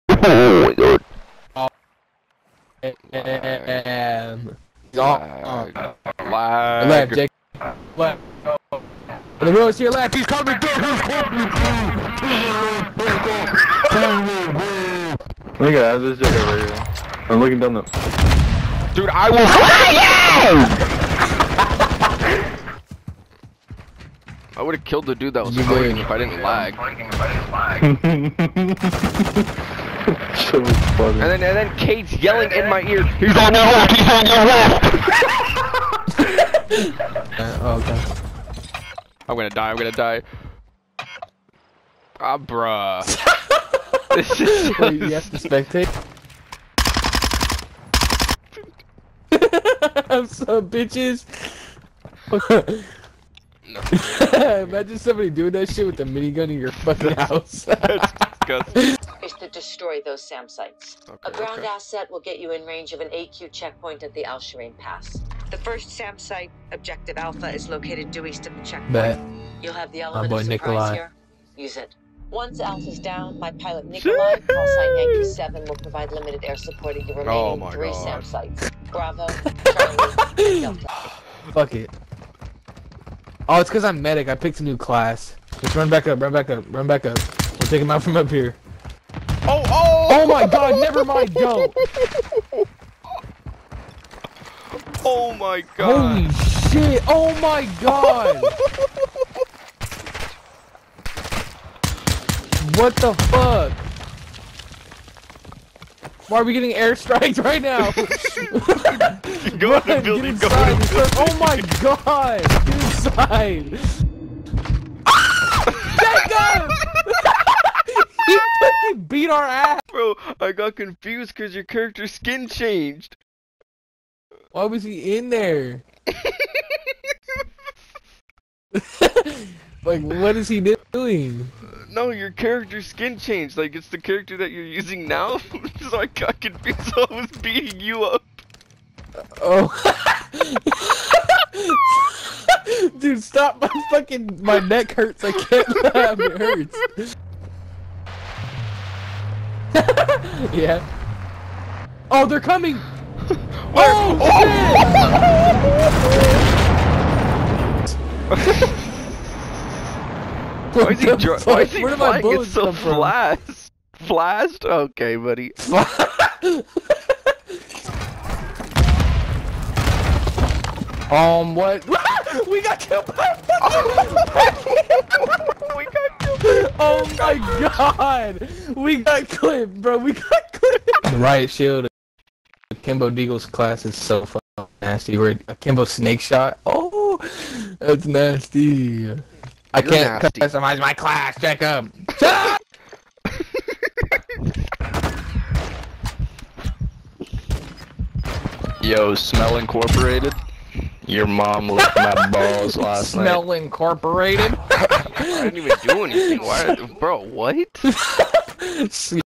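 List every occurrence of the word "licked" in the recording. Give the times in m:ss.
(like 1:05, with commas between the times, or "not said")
3:21.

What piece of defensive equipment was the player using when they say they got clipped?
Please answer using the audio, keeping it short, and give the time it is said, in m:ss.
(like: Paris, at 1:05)
Riot shield, at 3:01.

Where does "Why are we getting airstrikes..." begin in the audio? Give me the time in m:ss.
1:46.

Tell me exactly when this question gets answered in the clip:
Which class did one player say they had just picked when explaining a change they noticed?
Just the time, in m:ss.
1:24.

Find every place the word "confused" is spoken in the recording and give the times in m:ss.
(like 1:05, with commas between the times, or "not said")
2:00, 2:16.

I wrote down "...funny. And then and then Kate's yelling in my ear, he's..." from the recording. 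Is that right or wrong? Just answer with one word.
right.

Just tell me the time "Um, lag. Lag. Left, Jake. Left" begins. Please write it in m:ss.
0:04.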